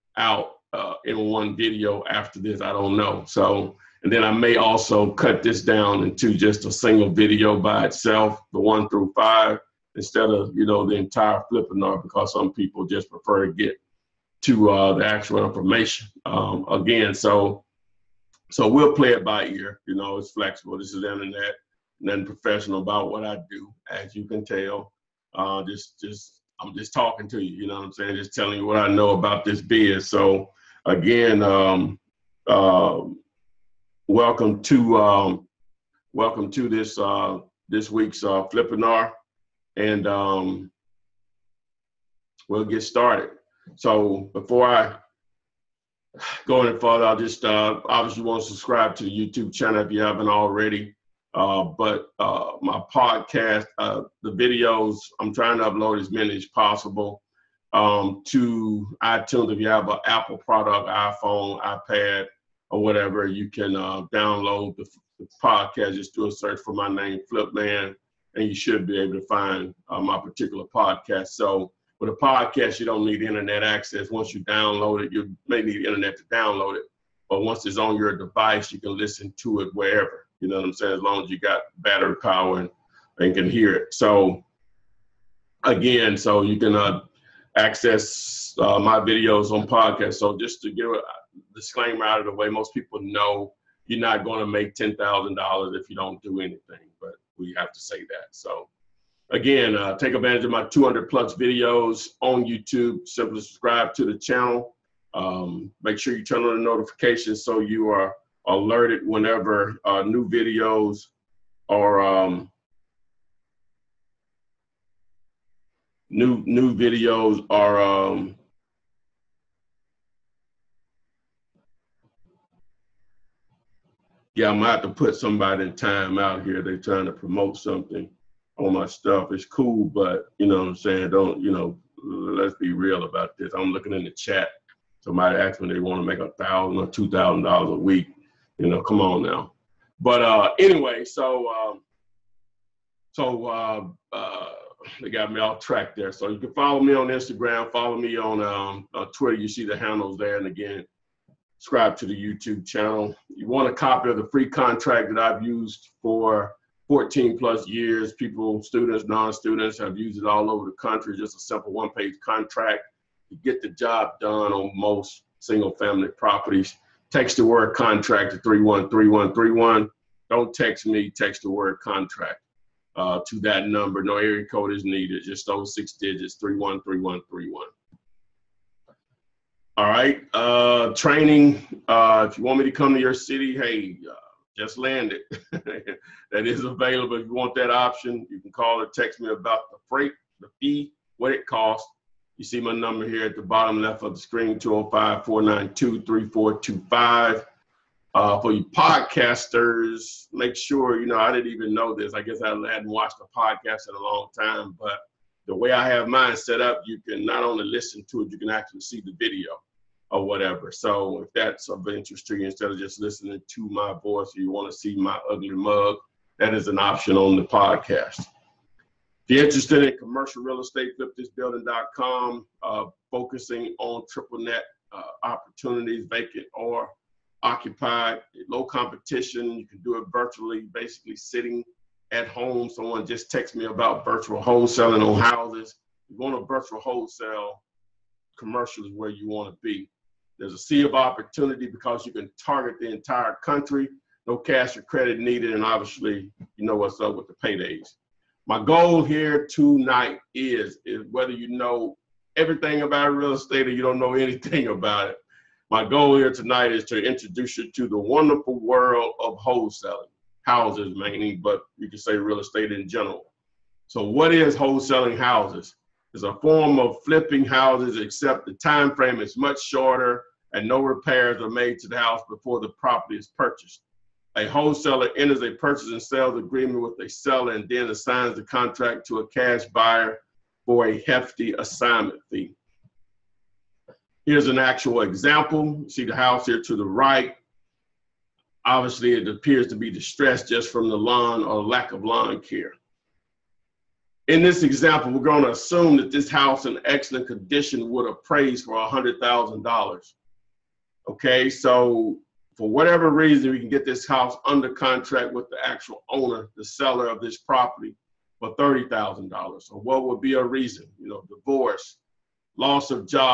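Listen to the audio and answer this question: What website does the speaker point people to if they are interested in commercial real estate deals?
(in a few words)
flipthisbuilding.com.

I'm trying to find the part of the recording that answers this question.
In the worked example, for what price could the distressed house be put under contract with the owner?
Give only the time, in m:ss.
5:08.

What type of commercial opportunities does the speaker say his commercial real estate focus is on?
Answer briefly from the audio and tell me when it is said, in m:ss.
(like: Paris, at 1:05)
triple net, at 3:44.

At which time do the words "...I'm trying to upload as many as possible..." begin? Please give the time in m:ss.
0:55.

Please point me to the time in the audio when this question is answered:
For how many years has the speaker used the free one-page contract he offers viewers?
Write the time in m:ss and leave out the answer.
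2:36.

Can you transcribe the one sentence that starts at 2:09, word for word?
It's cool, but you know what I'm saying?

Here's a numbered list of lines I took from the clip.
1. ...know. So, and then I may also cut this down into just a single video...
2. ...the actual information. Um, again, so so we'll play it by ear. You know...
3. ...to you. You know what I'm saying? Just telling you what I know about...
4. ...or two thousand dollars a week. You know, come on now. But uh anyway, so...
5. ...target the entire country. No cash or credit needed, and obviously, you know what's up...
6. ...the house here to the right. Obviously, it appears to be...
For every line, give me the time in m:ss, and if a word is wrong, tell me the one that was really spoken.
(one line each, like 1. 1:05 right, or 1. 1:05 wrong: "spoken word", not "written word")
1. 0:02 right
2. 0:14 right
3. 0:27 right
4. 2:16 right
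5. 4:02 right
6. 4:46 right.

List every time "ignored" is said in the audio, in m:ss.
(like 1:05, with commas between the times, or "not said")
not said.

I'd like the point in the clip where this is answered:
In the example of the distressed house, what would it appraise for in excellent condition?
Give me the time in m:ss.
4:58.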